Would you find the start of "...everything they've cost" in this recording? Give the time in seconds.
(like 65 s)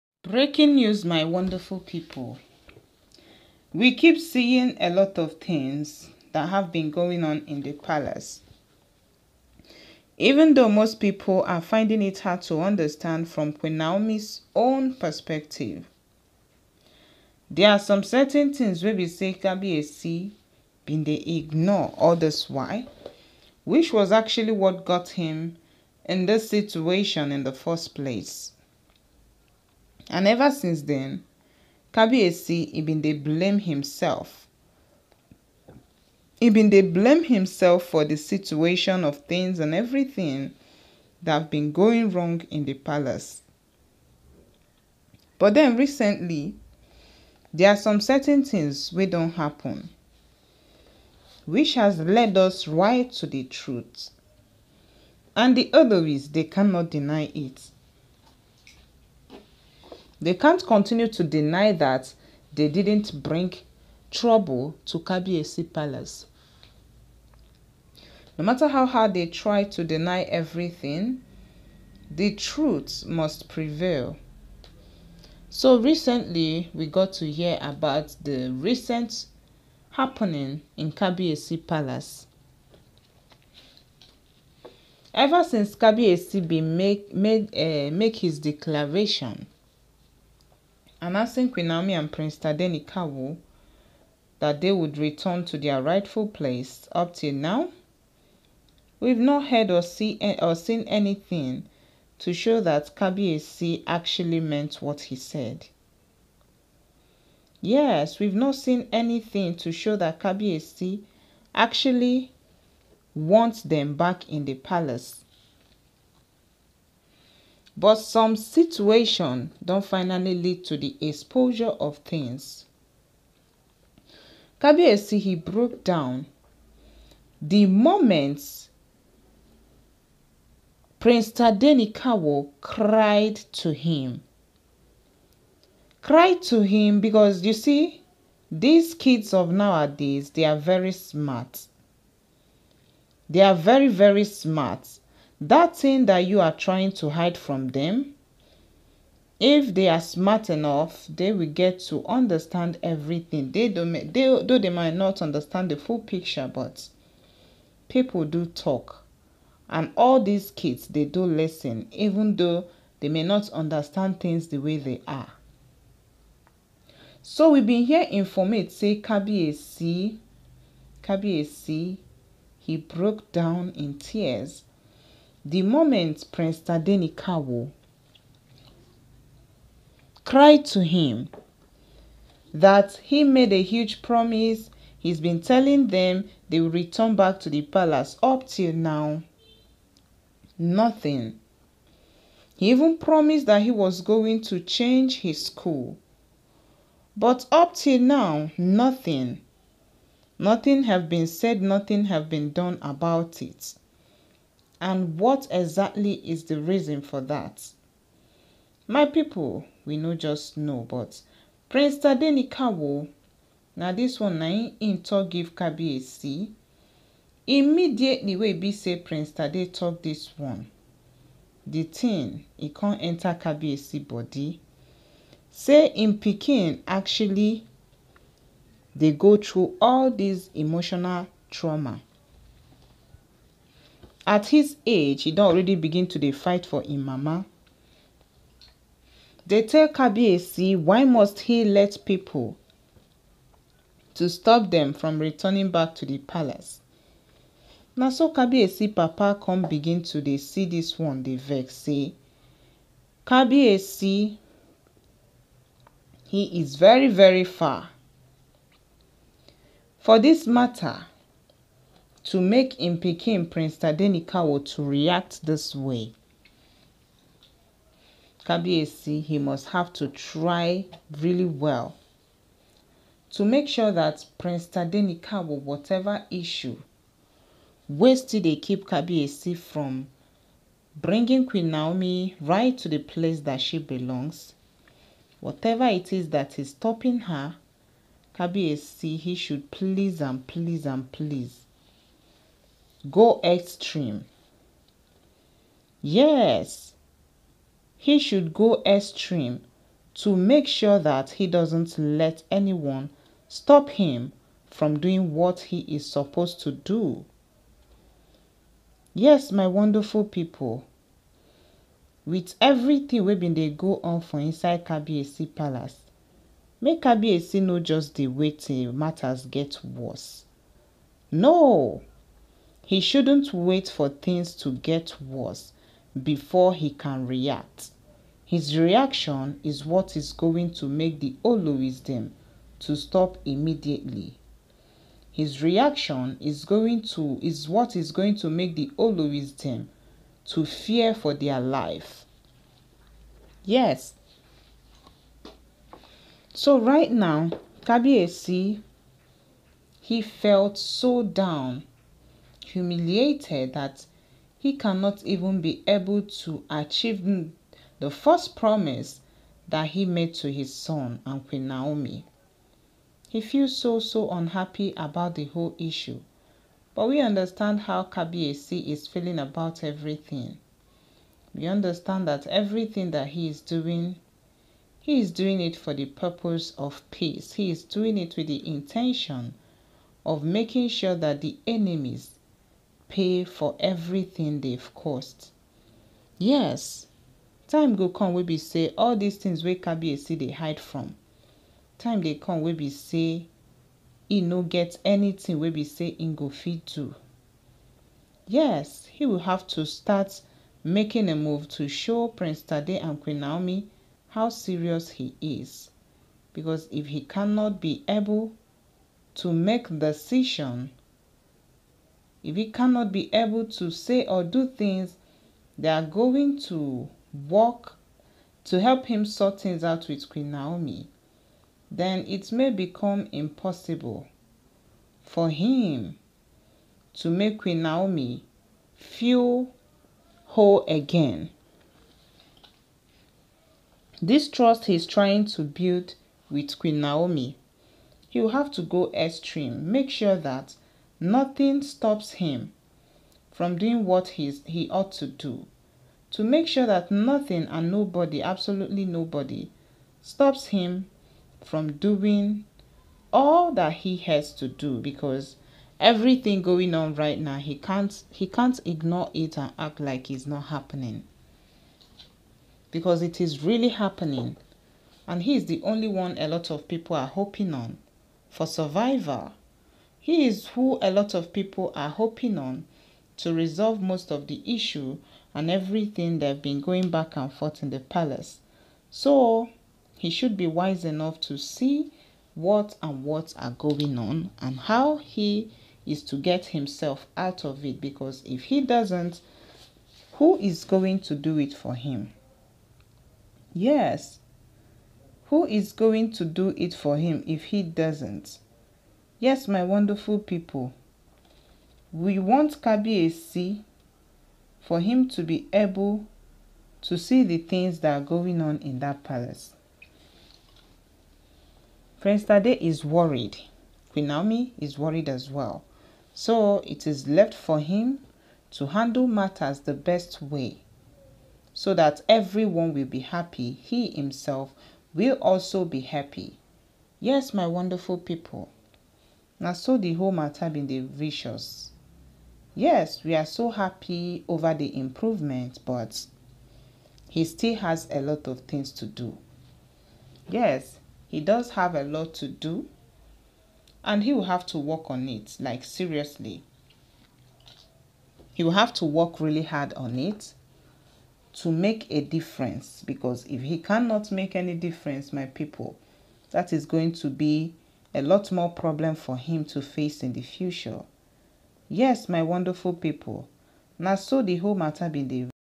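383 s.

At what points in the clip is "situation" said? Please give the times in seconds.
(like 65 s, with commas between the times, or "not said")
26 s, 38 s, 118 s.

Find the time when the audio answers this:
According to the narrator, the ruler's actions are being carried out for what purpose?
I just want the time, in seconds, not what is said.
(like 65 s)
377 s.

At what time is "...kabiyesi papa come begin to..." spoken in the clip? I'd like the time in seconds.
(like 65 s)
248 s.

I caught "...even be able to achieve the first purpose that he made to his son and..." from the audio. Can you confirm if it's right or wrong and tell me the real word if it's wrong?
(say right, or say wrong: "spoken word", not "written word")
wrong: "promise", not "purpose".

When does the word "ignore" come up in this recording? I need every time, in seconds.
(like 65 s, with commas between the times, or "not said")
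21 s, 458 s.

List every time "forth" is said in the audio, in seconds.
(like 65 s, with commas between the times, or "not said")
477 s.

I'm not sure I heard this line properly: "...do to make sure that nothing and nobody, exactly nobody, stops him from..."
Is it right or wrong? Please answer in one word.
wrong.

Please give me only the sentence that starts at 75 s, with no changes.
So recently, we got to hear about the recent happening in Kabiesi Palace.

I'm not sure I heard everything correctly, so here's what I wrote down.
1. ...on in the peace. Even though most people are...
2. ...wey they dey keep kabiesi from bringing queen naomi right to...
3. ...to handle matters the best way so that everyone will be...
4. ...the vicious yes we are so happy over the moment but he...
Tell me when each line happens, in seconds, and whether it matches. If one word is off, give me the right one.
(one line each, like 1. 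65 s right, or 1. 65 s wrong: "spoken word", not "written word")
1. 7 s wrong: "palace", not "peace"
2. 277 s right
3. 518 s right
4. 530 s wrong: "improvement", not "moment".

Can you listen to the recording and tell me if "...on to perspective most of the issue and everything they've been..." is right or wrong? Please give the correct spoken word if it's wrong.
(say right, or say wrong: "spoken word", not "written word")
wrong: "resolve", not "perspective".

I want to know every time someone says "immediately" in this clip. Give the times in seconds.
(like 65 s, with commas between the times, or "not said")
217 s, 333 s.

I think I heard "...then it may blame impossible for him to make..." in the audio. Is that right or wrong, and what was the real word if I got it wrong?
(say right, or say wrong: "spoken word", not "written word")
wrong: "become", not "blame".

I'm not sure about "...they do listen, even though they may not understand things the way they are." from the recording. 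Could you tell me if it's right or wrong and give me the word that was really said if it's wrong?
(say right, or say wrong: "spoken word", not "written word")
right.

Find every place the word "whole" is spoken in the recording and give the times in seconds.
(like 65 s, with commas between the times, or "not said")
365 s, 430 s, 530 s, 564 s.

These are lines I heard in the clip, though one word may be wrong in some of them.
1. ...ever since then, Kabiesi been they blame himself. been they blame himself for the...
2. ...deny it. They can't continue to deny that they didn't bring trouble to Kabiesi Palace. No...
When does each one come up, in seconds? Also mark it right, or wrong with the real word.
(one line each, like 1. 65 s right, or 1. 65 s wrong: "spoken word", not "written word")
1. 30 s right
2. 56 s right.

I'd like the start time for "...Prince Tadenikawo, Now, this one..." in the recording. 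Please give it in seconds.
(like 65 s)
211 s.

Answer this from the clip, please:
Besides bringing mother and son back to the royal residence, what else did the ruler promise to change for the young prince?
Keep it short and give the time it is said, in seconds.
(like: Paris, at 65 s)
His school, at 195 s.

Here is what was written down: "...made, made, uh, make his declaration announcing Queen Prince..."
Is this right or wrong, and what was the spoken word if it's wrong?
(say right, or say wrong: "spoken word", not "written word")
wrong: "Naomi", not "Prince".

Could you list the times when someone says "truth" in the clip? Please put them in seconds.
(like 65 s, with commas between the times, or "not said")
53 s, 72 s.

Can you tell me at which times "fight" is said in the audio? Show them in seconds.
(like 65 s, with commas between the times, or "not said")
236 s.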